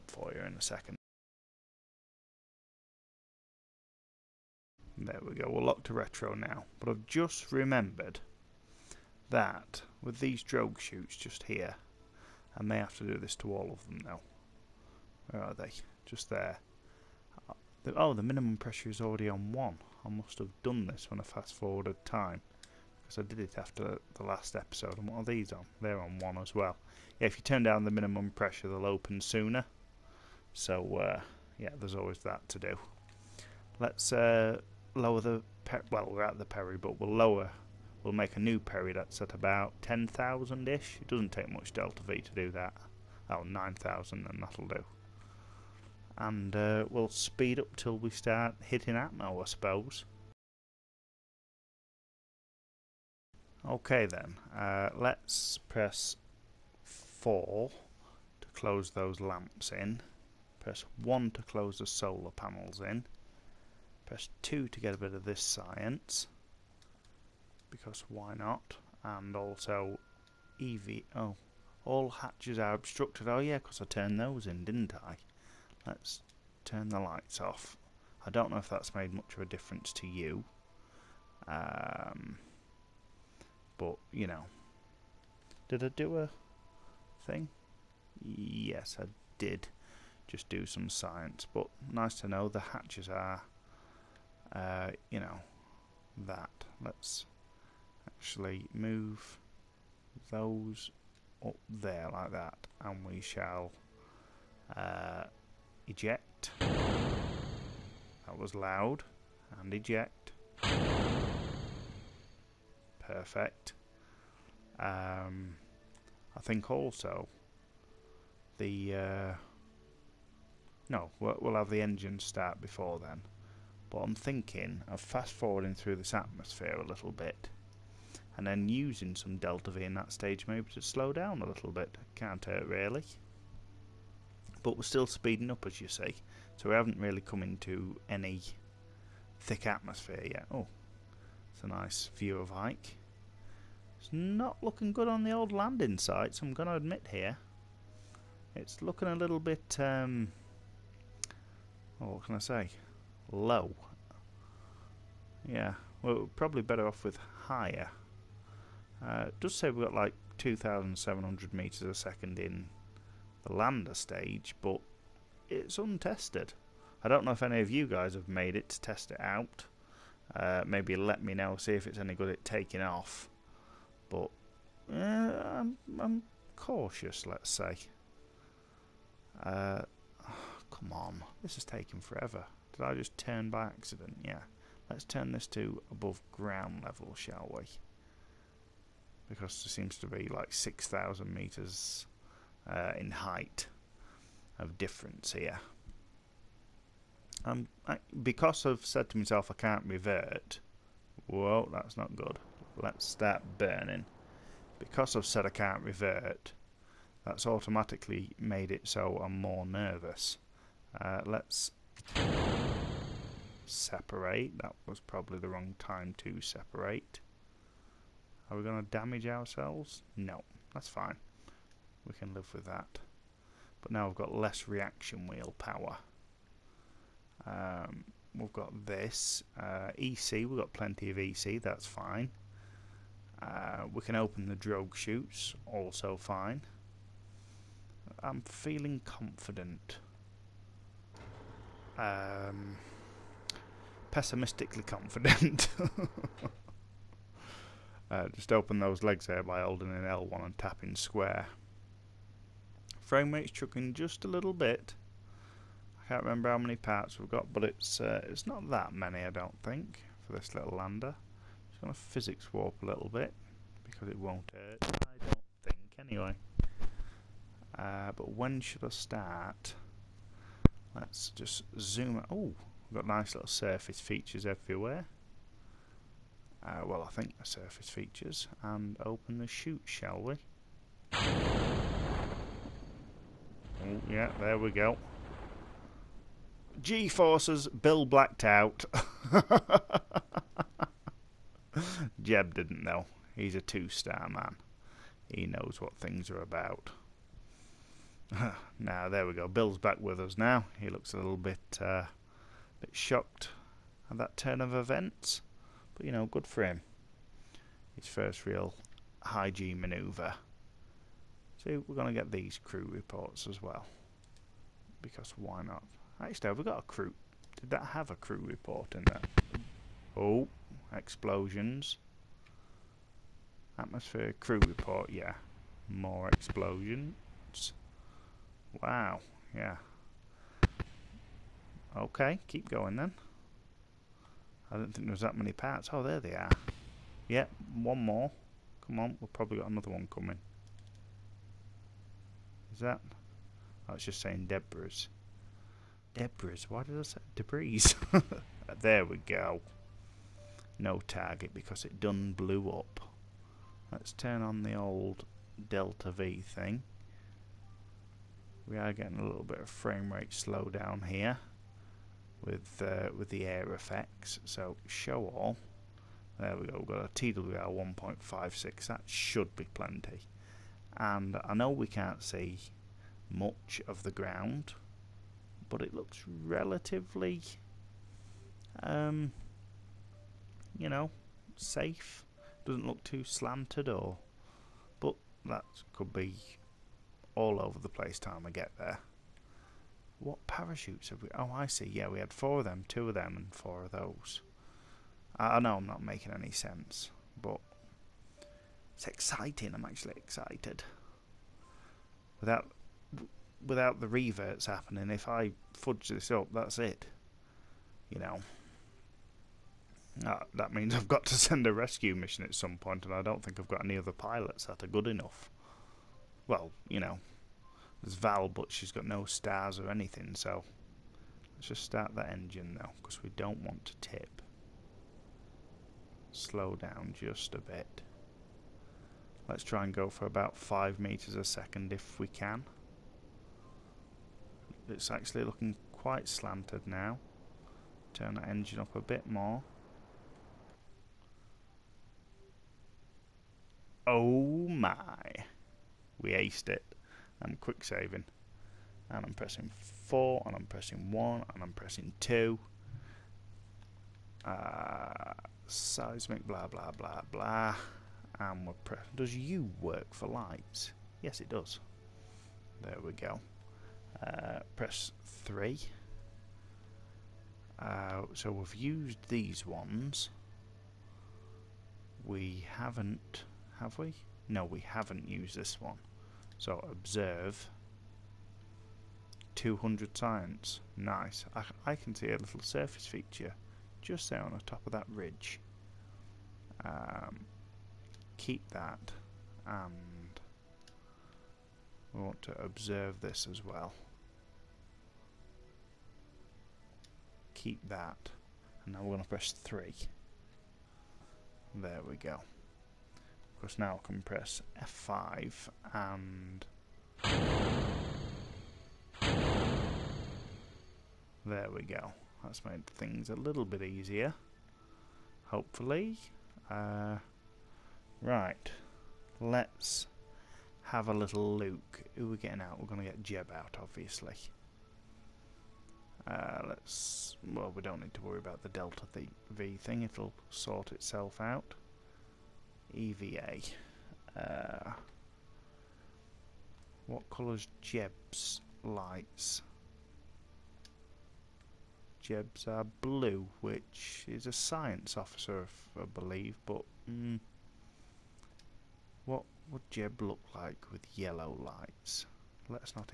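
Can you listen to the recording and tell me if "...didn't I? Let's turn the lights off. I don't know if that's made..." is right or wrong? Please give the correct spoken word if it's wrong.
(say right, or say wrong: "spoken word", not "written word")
right.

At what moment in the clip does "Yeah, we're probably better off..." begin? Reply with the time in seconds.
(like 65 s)
155 s.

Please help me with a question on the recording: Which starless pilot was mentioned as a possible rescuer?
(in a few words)
Val.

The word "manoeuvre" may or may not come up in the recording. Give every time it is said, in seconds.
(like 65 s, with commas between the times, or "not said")
309 s.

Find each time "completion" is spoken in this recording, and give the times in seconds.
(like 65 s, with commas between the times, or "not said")
not said.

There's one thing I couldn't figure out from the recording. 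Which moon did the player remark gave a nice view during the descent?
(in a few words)
Ike.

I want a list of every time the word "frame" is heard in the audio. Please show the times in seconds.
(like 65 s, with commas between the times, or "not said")
253 s, 359 s.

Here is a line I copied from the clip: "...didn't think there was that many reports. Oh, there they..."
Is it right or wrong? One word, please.
wrong.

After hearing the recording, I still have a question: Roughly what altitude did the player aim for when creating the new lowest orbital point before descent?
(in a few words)
9,000.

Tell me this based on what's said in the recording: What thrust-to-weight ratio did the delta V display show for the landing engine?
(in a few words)
1.56.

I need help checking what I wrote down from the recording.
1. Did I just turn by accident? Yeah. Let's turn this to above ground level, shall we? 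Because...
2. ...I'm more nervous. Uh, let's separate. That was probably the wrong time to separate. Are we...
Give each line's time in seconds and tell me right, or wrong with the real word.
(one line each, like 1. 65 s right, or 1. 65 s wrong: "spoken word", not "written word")
1. 182 s right
2. 209 s right.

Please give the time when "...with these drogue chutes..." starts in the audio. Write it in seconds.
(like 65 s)
10 s.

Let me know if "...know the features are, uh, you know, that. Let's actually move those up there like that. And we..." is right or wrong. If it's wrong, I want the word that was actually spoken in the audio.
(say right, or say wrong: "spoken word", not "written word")
wrong: "hatches", not "features".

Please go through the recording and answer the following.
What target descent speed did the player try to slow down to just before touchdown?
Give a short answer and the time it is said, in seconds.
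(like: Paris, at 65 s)
5 meters a second, at 430 s.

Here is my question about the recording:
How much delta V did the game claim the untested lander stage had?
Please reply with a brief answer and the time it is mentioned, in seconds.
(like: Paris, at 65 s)
2,700 metres a second, at 160 s.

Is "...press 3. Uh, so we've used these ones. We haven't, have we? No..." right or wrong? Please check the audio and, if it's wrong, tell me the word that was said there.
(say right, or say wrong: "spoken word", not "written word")
right.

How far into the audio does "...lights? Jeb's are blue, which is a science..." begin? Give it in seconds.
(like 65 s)
538 s.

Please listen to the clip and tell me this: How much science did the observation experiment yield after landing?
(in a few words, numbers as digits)
200.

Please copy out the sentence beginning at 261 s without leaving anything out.
Just going to physics warp a little bit, because it won't hurt, I don't think, anyway.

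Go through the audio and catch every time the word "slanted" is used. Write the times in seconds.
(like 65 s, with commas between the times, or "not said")
383 s, 436 s.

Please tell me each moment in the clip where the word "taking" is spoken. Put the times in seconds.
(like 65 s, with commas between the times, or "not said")
172 s, 181 s.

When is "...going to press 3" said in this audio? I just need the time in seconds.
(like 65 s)
499 s.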